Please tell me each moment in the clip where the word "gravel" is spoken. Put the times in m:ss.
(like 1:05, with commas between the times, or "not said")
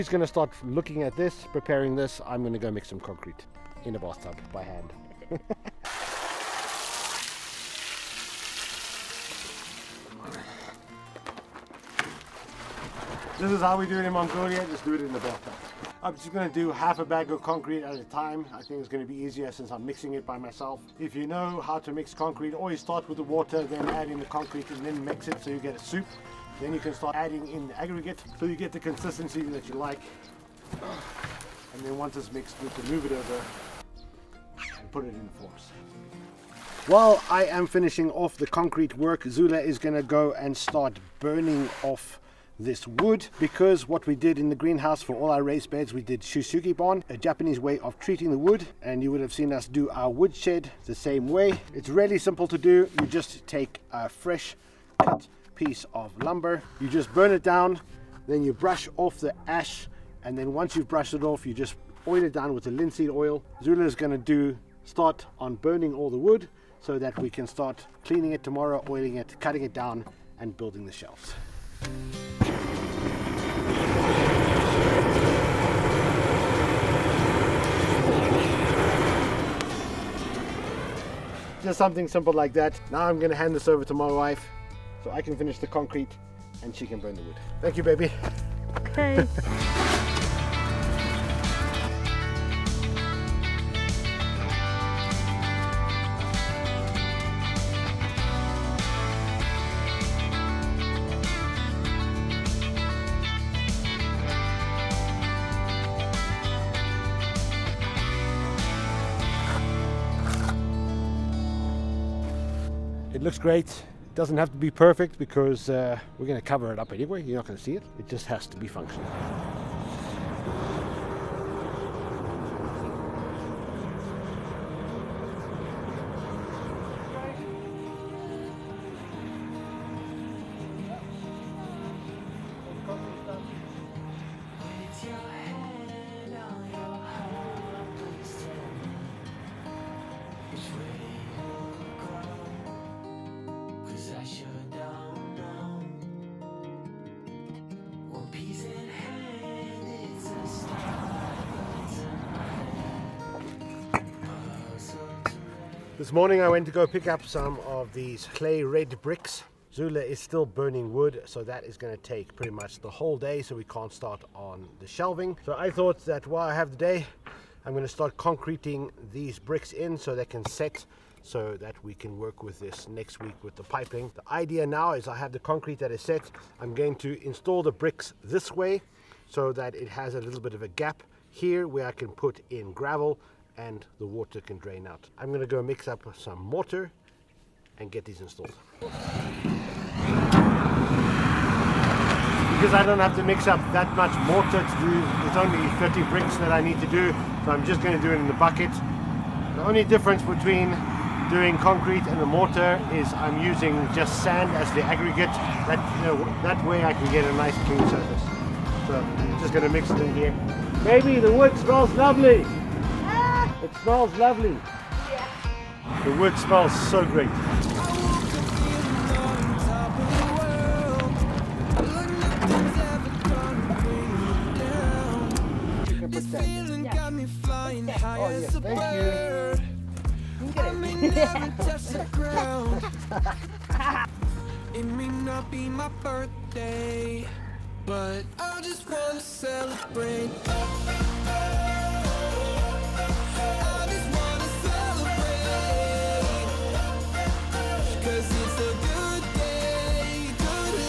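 3:02.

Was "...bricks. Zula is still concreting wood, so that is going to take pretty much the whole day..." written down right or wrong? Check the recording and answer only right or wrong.
wrong.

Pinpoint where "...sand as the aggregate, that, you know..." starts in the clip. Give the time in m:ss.
3:24.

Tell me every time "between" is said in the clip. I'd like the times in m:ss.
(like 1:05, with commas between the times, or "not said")
3:20.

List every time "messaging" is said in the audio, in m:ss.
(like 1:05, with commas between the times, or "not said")
not said.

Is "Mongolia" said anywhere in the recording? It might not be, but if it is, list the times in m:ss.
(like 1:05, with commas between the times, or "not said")
0:14.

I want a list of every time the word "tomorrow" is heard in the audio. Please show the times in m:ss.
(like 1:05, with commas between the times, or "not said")
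1:08.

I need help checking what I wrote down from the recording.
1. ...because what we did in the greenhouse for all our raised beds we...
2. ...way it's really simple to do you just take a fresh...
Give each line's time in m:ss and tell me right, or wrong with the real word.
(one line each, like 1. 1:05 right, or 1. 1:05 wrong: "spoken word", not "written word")
1. 0:43 right
2. 0:51 right.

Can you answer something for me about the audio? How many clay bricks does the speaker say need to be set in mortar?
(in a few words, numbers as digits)
30.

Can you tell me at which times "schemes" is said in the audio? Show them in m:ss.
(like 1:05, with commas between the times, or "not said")
not said.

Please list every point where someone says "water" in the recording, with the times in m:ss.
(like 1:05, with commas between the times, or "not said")
0:23, 3:04.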